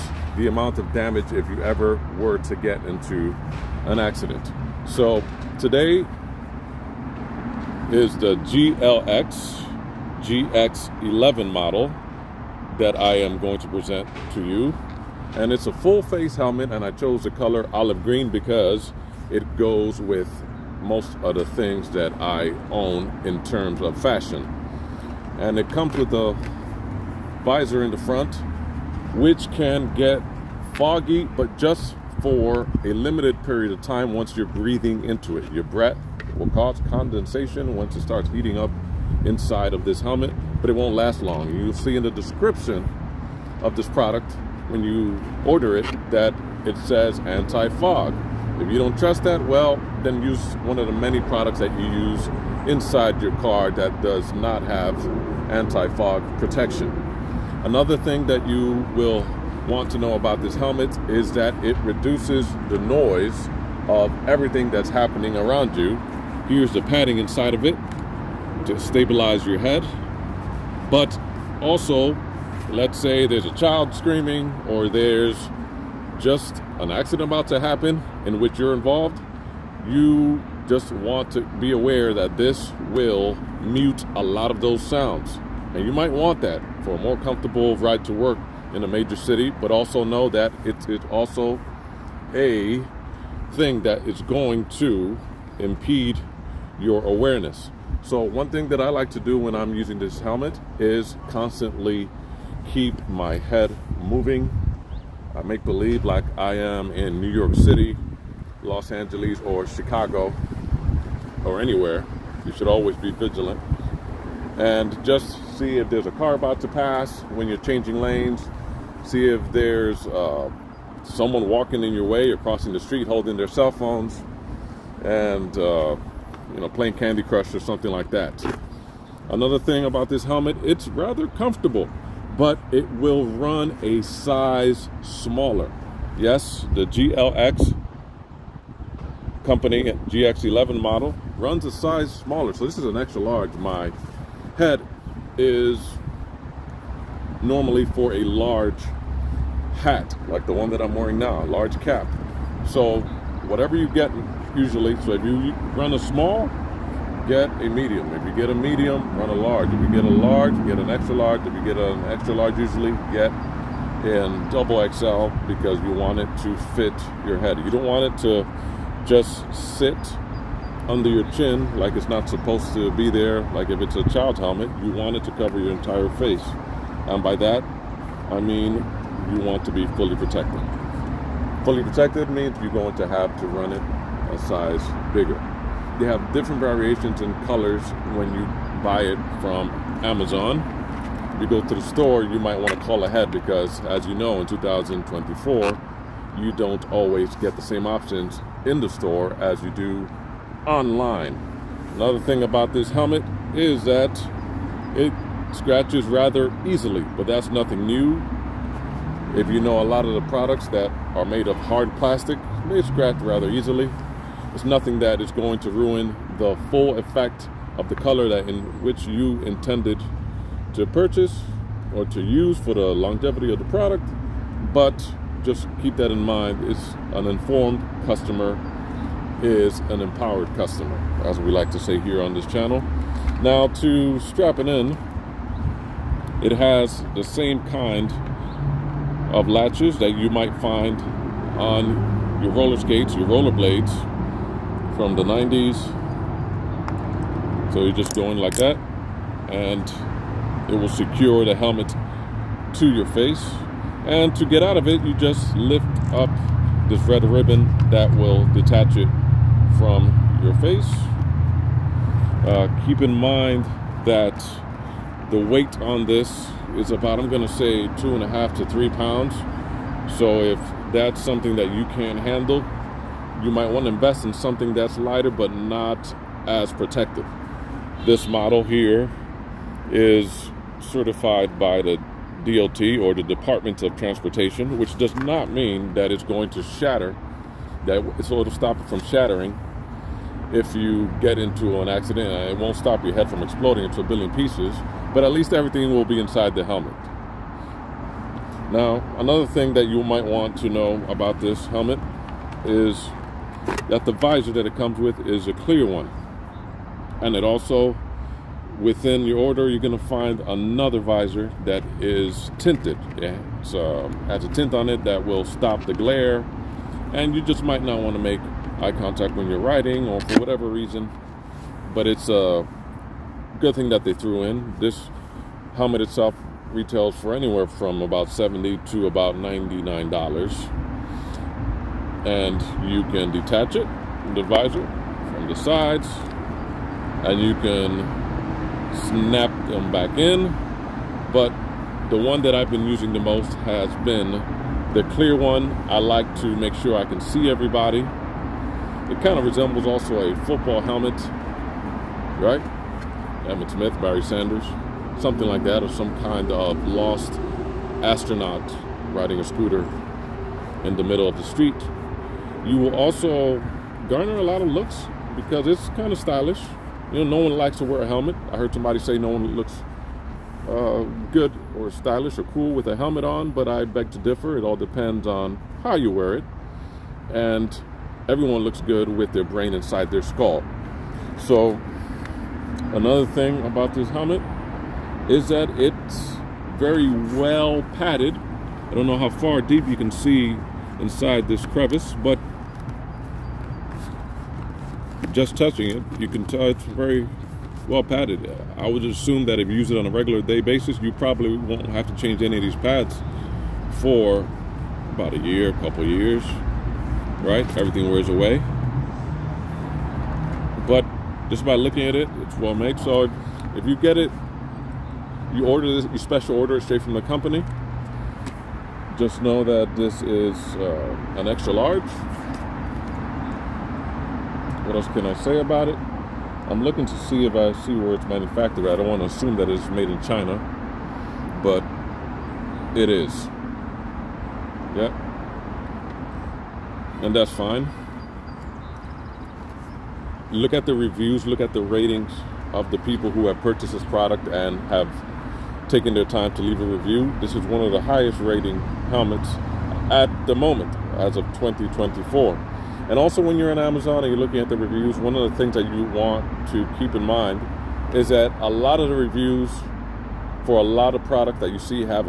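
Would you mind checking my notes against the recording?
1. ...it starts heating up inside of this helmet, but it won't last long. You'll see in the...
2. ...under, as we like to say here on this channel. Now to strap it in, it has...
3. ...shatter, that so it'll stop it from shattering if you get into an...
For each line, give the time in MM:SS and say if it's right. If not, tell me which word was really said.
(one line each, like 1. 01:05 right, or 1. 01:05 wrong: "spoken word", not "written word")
1. 00:37 right
2. 03:50 wrong: "customer", not "under"
3. 04:46 right.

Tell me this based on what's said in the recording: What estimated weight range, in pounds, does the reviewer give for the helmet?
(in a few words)
2.5 to 3 pounds.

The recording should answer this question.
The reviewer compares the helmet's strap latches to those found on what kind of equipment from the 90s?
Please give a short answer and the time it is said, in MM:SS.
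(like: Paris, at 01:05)
roller skates, at 04:02.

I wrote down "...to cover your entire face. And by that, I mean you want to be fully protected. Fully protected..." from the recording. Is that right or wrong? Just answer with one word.
right.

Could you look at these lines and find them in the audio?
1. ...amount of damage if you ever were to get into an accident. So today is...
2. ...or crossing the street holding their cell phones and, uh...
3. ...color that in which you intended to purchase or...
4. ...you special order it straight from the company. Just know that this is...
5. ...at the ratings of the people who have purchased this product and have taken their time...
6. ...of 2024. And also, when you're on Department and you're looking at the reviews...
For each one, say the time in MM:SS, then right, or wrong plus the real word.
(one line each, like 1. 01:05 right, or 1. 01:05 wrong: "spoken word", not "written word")
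1. 00:00 right
2. 02:02 right
3. 03:37 right
4. 06:56 right
5. 07:21 right
6. 07:31 wrong: "Amazon", not "Department".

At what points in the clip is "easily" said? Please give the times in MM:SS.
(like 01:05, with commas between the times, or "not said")
03:26, 03:33.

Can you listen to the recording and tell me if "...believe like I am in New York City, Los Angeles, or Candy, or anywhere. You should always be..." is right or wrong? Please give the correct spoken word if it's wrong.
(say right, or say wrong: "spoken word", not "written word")
wrong: "Chicago", not "Candy".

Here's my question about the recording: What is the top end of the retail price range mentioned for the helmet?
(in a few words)
$99.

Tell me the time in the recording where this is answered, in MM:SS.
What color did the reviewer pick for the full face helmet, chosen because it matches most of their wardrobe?
00:17.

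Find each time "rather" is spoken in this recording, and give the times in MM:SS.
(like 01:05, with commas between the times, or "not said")
02:10, 03:26, 03:33.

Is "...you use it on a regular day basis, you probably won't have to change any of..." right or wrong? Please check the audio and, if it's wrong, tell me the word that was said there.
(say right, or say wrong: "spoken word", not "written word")
right.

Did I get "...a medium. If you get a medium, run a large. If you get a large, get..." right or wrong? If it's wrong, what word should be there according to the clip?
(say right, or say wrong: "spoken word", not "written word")
right.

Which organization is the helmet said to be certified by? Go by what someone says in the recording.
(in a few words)
Department of Transportation.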